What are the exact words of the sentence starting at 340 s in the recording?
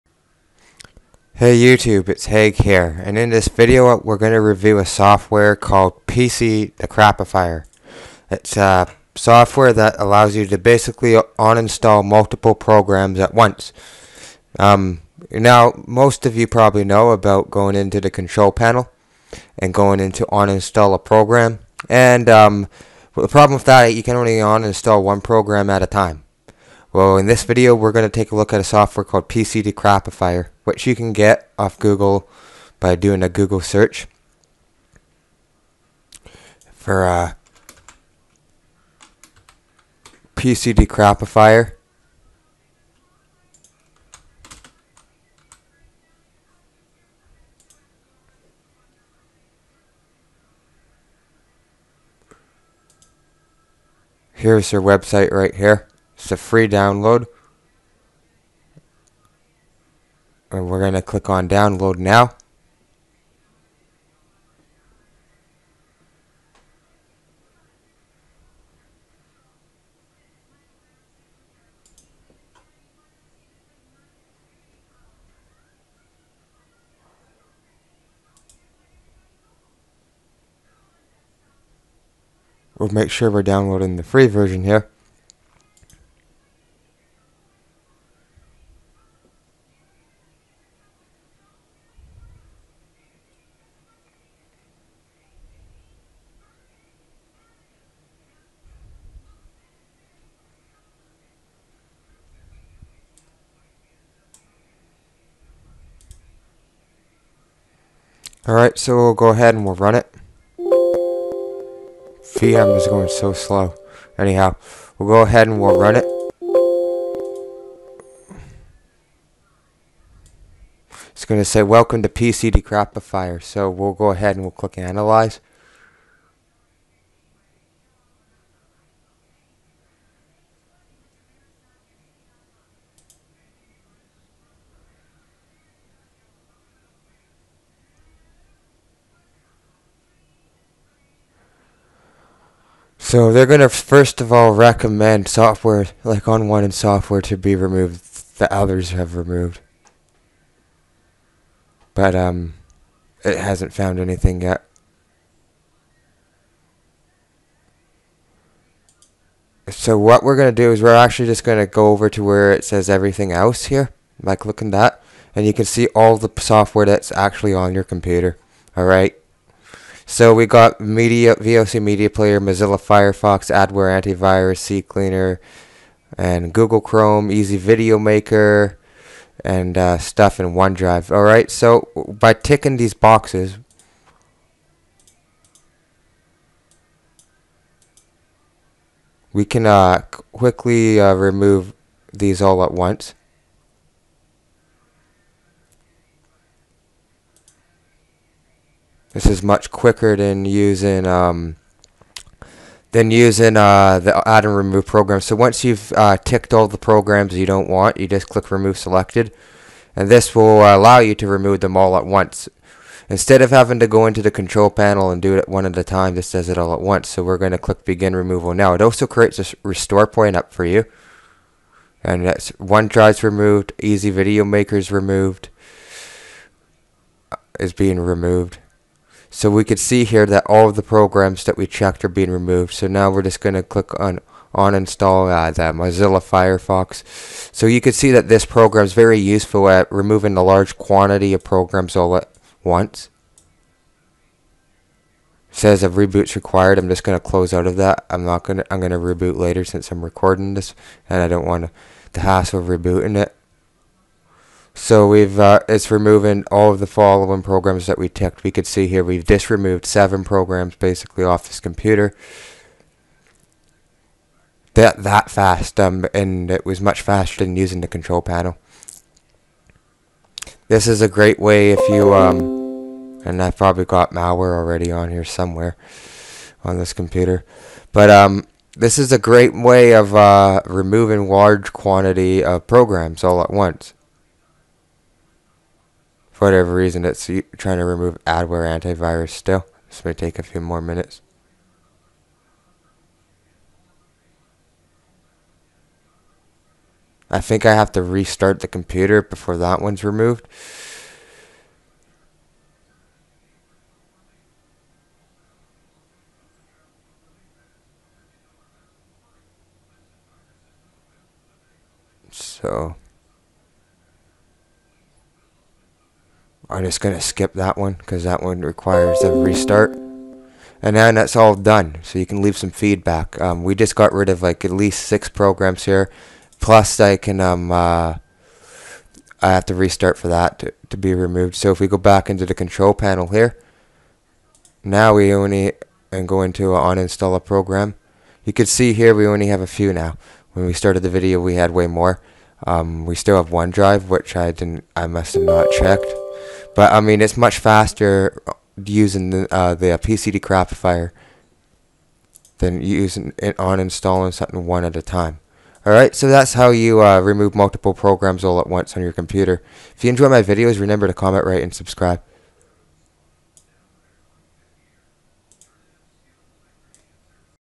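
When we started the video we had way more.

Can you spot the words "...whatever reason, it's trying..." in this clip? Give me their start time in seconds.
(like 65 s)
286 s.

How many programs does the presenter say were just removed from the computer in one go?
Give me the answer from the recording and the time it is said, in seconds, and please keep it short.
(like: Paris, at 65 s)
7, at 259 s.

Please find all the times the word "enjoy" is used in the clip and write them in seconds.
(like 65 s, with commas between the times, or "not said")
360 s.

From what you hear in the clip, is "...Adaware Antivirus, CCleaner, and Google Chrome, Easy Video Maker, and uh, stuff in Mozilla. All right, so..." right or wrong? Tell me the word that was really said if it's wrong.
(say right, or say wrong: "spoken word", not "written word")
wrong: "OneDrive", not "Mozilla".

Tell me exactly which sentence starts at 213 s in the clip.
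Instead of having to go into the control panel and do it one at a time, this does it all at once.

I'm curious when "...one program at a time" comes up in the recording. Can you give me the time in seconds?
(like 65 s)
25 s.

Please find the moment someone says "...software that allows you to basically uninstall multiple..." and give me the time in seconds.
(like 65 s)
9 s.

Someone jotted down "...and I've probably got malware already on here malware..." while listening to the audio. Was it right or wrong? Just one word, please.
wrong.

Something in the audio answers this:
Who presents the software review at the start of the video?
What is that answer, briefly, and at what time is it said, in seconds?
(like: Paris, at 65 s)
Haig, at 2 s.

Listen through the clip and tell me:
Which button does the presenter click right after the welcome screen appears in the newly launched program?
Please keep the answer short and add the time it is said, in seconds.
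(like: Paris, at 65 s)
analyze, at 124 s.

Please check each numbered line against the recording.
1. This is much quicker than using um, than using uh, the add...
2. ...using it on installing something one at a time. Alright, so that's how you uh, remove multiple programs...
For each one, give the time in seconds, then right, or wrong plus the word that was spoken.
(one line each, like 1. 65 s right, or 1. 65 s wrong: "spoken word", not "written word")
1. 199 s right
2. 352 s right.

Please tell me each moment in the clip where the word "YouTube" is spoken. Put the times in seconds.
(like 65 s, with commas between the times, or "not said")
1 s.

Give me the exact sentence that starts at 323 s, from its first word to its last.
Um, we just got rid of like at least six programs here.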